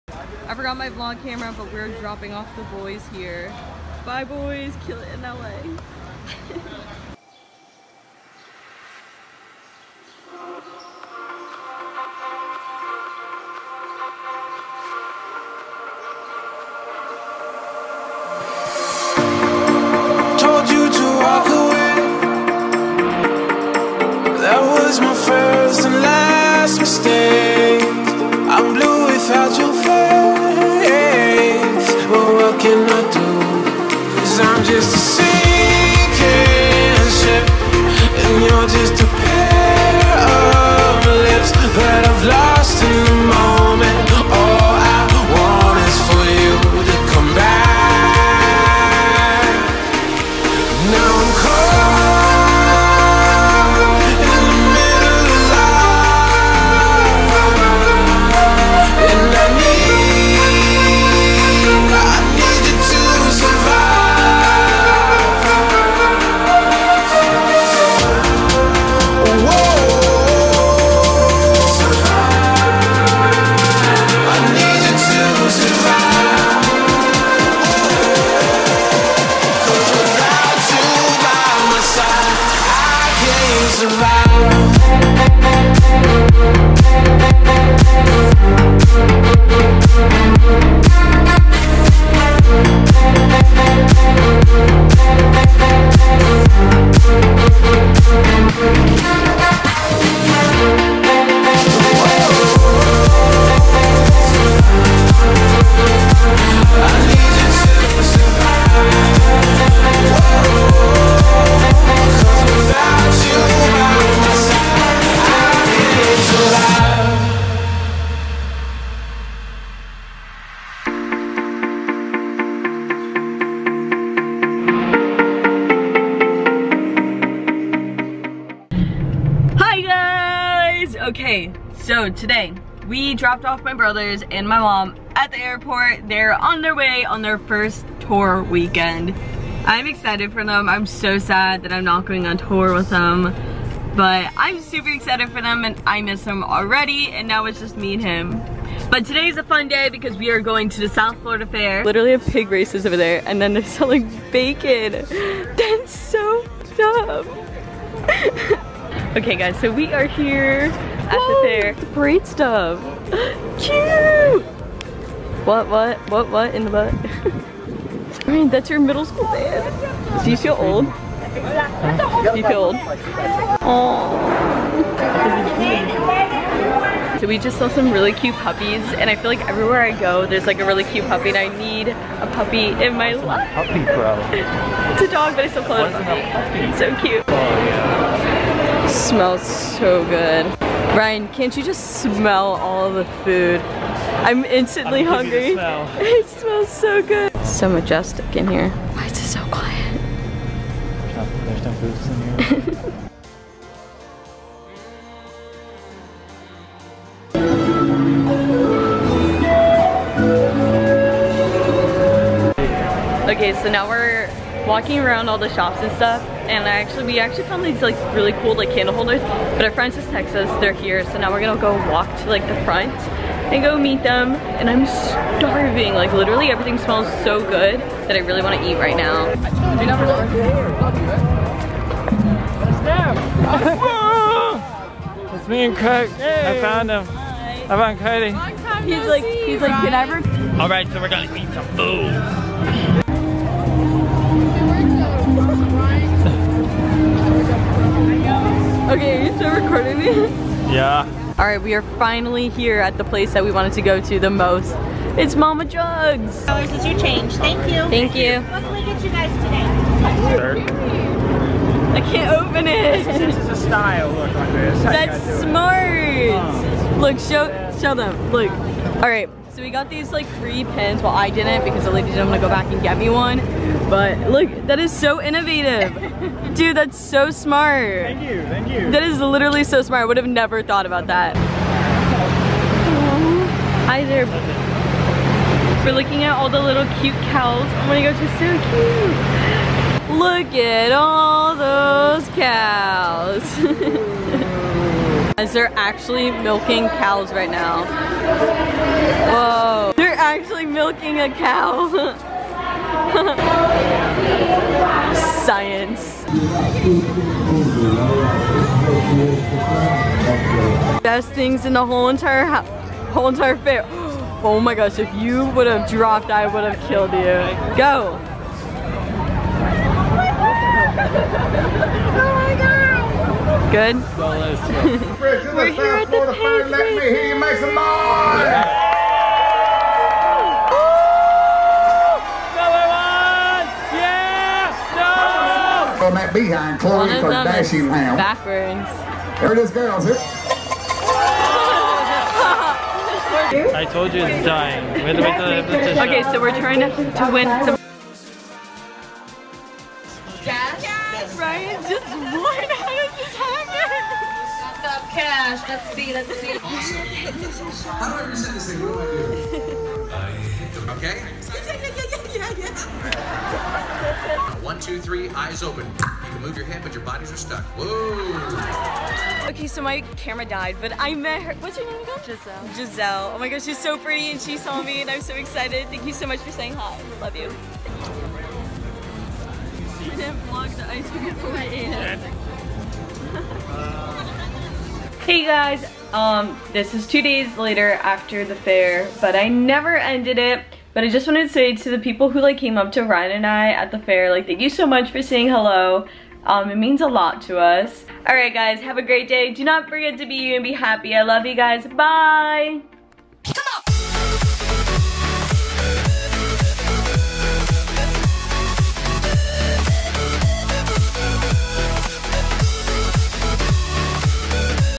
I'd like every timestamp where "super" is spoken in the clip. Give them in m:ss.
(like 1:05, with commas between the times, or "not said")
2:24.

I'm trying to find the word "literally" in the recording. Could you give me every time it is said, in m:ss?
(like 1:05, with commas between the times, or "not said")
2:31, 3:46, 4:39.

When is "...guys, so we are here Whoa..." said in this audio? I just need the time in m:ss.
2:39.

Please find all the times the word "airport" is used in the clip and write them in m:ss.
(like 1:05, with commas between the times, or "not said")
2:15.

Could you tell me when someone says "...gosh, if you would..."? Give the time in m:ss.
5:14.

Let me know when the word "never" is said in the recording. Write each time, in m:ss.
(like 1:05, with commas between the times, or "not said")
4:40, 6:29.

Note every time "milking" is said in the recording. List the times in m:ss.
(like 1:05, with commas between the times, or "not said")
4:56, 5:00.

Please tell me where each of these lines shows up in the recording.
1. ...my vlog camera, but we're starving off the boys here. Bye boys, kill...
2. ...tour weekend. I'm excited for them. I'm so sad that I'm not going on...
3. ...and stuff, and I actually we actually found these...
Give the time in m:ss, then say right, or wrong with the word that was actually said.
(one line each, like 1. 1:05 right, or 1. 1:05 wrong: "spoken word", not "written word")
1. 0:00 wrong: "dropping", not "starving"
2. 2:18 right
3. 3:35 right.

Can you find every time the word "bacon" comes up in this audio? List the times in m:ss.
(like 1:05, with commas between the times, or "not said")
2:34.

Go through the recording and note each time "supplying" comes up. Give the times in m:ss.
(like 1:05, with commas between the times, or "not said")
not said.